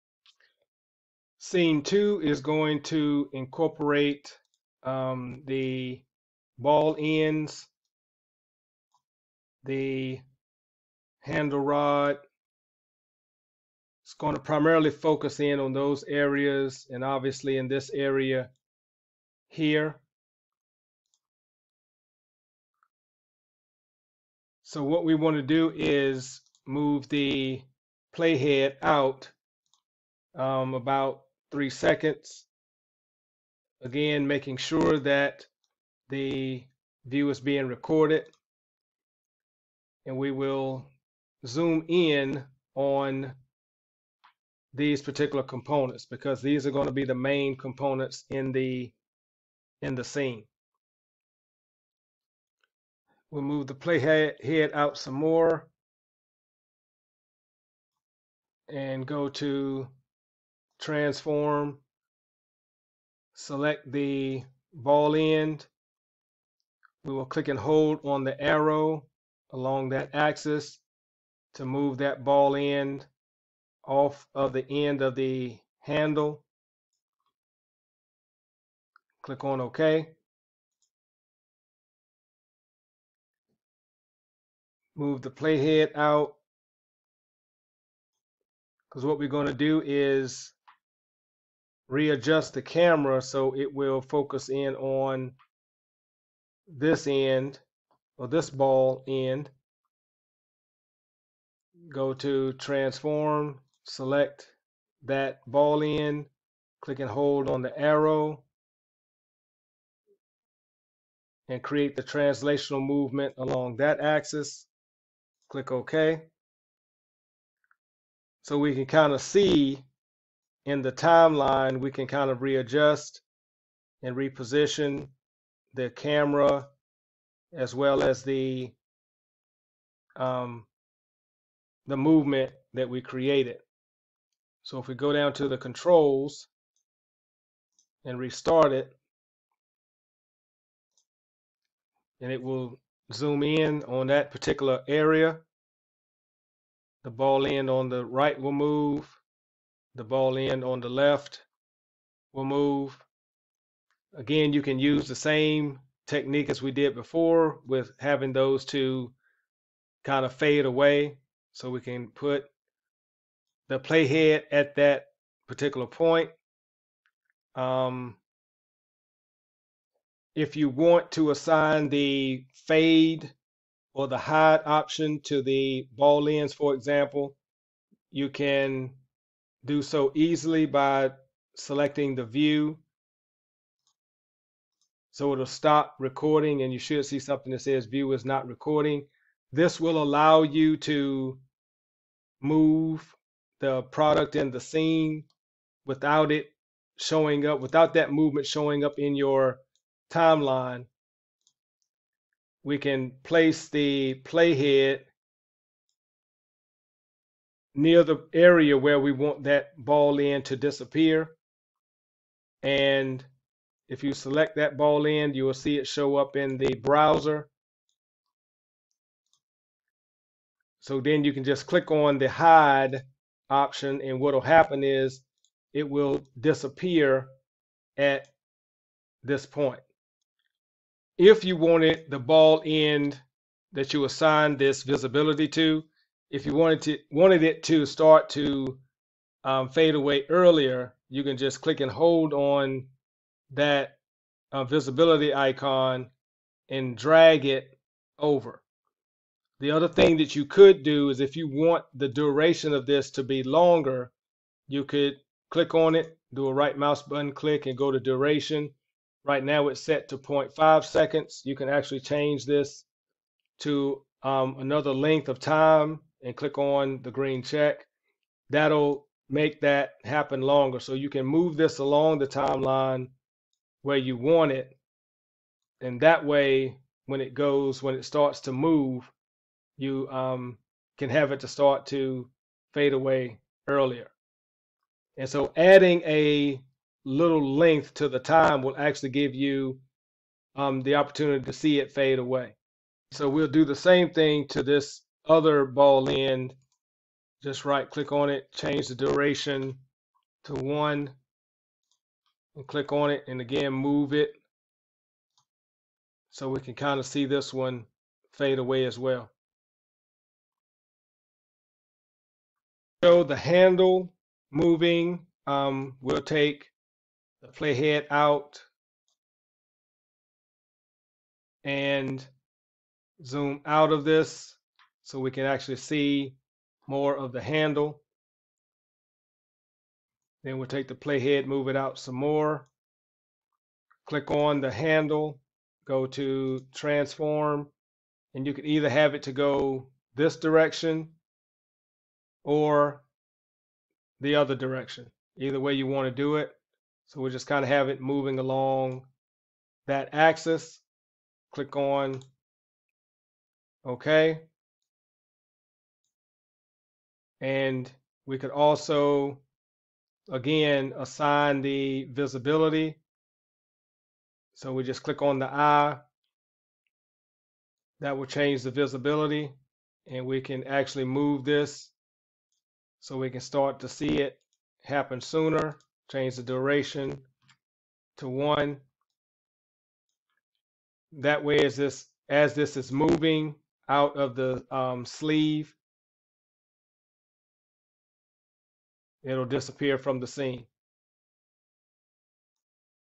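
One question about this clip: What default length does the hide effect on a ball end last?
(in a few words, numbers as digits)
0.5 seconds.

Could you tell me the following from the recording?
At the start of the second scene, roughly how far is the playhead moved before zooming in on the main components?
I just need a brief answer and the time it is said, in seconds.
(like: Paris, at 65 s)
3 seconds, at 31 s.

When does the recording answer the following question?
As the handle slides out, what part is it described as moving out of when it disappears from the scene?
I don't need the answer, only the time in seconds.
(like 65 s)
385 s.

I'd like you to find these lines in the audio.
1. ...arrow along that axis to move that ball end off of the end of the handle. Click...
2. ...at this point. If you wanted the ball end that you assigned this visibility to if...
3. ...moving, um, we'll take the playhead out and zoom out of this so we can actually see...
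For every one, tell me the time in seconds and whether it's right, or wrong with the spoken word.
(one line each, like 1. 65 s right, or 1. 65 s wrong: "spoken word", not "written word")
1. 68 s right
2. 227 s right
3. 314 s right.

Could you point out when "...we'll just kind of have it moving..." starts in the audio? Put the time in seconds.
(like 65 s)
347 s.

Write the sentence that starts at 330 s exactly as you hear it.
Then we'll take the playhead, move it out some more.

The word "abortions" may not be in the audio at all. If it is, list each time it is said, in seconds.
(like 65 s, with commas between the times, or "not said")
not said.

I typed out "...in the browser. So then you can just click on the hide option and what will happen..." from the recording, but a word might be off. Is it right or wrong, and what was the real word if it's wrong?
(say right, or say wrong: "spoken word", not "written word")
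right.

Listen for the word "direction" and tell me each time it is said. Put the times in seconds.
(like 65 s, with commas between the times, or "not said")
340 s, 344 s.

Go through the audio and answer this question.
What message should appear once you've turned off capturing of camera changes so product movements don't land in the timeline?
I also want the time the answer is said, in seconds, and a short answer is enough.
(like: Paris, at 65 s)
view is not recording, at 187 s.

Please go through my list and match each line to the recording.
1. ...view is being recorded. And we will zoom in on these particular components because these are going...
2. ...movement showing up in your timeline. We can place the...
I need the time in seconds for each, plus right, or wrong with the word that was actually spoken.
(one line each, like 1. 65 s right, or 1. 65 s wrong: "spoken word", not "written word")
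1. 37 s right
2. 198 s right.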